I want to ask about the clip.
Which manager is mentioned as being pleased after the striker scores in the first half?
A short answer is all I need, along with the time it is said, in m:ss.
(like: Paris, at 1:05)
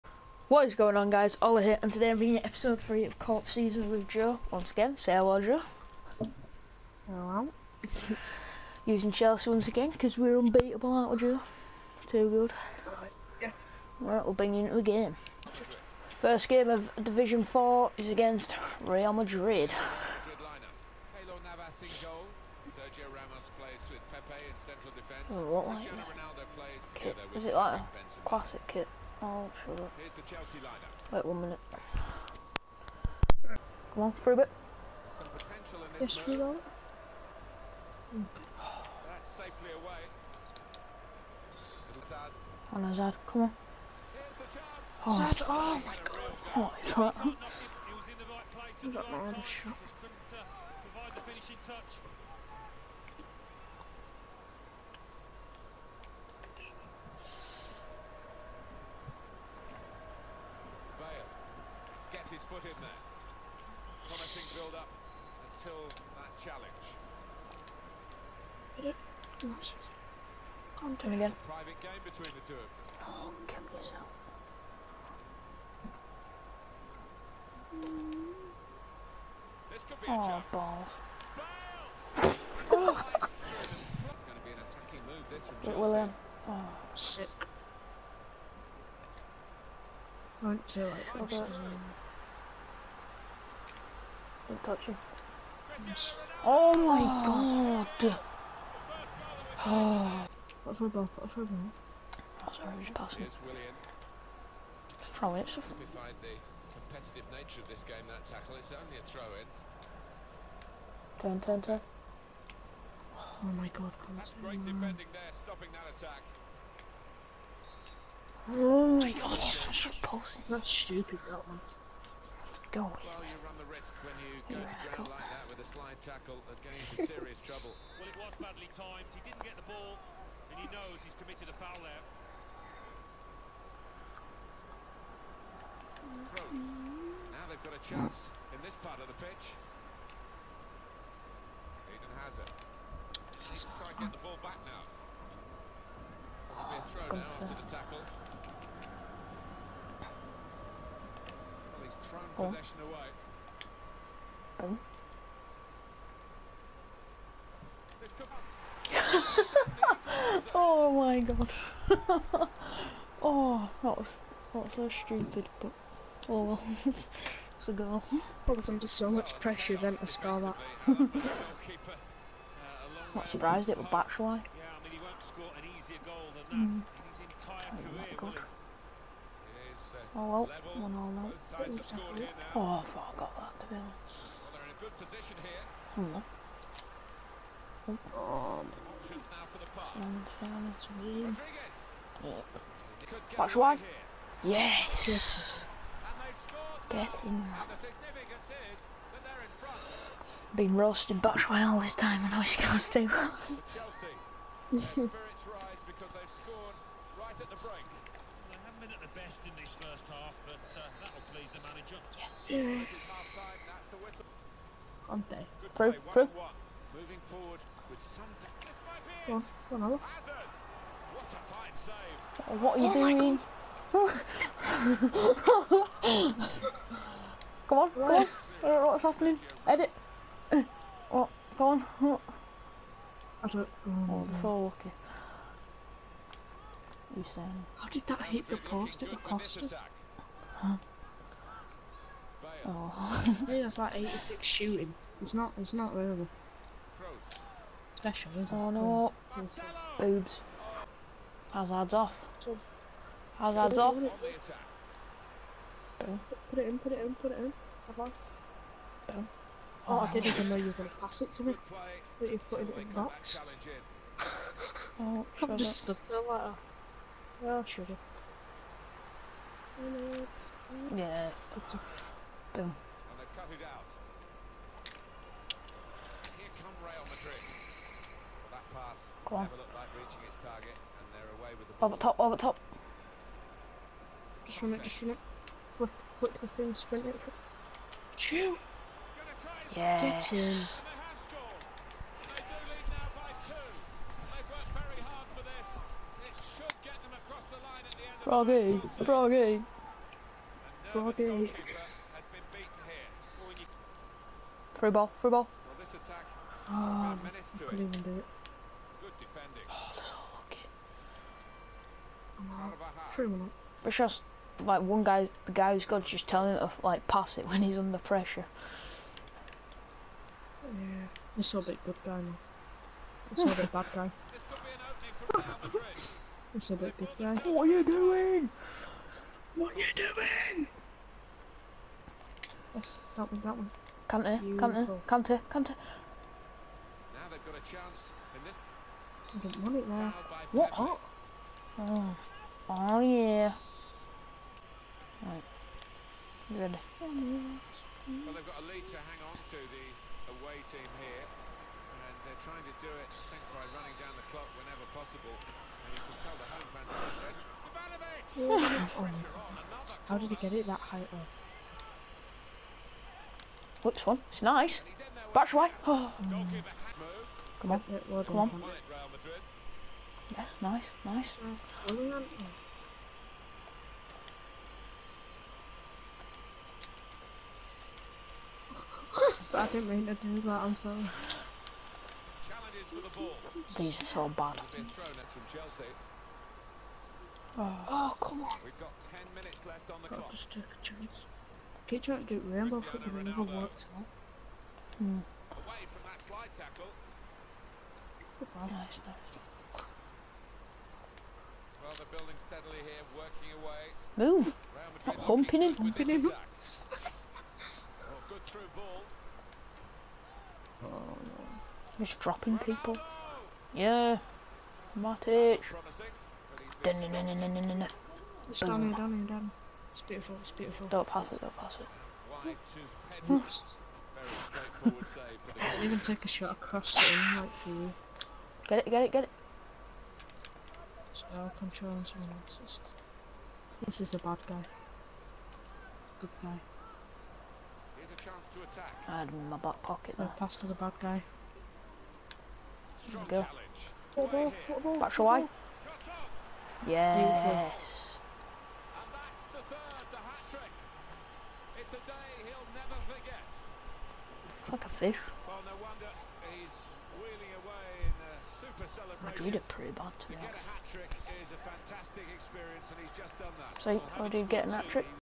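Conte, at 3:35.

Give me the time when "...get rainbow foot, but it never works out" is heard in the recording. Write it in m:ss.
6:32.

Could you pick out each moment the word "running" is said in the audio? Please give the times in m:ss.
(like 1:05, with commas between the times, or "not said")
5:53.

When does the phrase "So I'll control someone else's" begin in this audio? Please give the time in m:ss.
7:11.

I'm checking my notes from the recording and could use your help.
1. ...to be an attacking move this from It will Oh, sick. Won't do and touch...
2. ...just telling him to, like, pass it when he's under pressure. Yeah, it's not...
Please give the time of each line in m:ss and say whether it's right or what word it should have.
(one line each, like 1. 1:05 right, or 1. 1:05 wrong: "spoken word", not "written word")
1. 1:24 right
2. 5:16 right.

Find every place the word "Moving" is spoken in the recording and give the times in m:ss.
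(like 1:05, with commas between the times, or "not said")
3:36.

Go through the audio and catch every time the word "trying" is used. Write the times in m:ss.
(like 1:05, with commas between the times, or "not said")
2:23, 5:52, 6:32.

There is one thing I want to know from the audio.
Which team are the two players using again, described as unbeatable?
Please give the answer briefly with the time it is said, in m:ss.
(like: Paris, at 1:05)
Chelsea, at 0:09.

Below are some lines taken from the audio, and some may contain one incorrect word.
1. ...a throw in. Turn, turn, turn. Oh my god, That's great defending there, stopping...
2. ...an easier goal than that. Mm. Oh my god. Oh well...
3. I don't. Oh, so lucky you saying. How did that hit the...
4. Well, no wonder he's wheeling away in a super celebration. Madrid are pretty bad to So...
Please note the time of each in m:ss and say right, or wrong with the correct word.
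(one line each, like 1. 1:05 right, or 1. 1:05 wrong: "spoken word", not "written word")
1. 1:48 right
2. 2:55 right
3. 3:53 right
4. 7:35 right.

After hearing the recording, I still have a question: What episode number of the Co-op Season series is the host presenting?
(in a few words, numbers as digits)
3.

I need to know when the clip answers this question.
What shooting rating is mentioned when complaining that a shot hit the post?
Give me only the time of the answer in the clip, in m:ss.
4:03.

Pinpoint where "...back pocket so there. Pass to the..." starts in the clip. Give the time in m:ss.
7:19.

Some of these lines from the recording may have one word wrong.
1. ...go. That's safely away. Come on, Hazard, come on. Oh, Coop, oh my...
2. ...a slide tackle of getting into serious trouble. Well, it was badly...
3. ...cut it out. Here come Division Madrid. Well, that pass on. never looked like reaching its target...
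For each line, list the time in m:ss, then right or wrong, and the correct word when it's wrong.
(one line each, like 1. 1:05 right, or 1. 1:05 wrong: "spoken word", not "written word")
1. 0:36 wrong: "Zad", not "Coop"
2. 2:05 right
3. 4:33 wrong: "Real", not "Division".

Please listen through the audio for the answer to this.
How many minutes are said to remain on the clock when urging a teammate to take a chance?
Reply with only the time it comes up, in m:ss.
6:29.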